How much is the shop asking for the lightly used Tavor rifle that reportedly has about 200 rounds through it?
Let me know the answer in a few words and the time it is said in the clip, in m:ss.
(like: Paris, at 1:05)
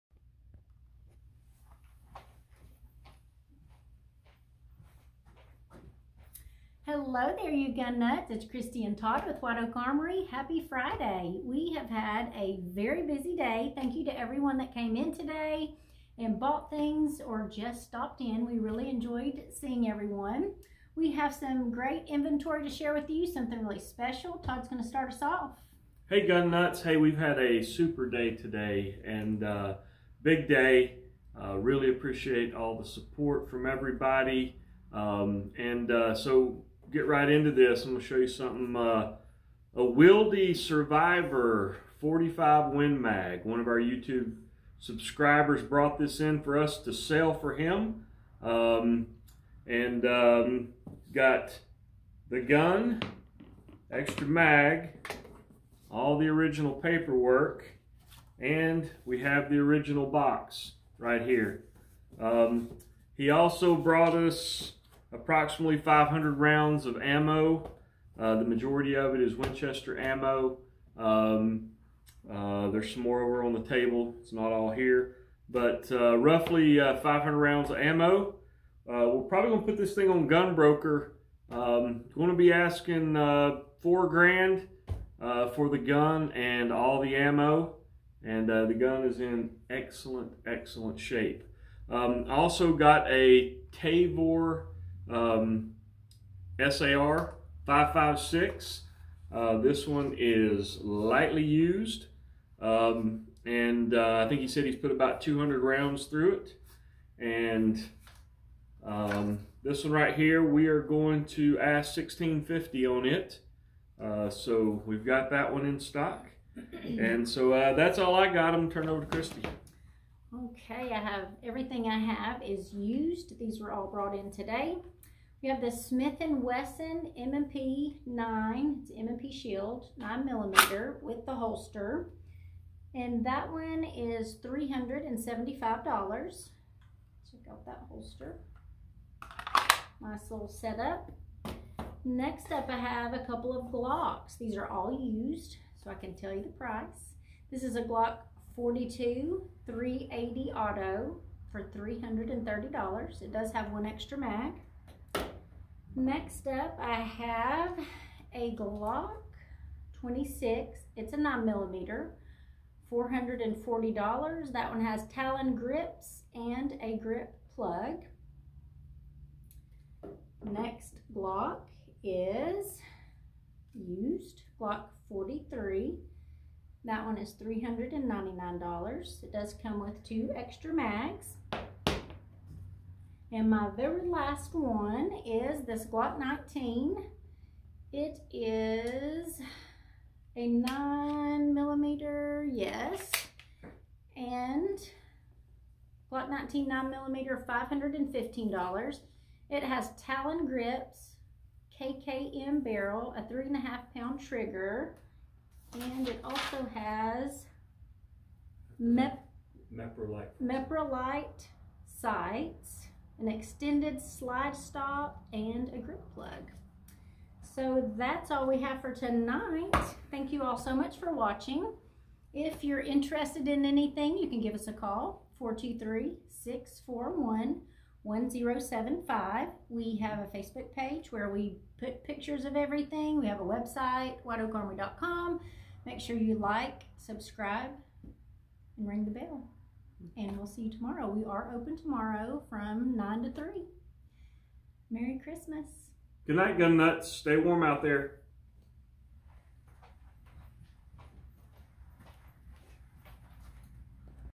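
$1,650, at 1:51.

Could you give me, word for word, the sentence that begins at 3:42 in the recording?
If you're interested in anything, you can give us a call, 423 641 1075.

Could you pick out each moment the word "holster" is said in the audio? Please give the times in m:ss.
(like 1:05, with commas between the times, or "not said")
2:11, 2:17.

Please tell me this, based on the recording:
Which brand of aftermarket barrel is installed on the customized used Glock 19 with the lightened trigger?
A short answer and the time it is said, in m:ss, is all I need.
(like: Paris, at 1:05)
KKM, at 3:21.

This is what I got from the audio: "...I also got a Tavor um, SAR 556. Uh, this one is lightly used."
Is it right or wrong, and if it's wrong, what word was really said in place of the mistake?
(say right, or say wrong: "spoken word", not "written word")
right.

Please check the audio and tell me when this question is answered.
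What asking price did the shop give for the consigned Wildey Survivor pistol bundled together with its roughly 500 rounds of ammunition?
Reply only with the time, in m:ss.
1:23.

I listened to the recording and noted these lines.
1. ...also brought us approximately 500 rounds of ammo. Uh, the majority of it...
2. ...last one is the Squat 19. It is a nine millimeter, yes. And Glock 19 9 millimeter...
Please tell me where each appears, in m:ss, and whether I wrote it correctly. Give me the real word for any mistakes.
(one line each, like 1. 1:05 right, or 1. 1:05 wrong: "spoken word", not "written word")
1. 1:03 right
2. 3:04 right.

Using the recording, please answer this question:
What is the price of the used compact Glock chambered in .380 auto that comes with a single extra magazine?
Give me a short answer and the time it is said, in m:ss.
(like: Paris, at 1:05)
$330, at 2:31.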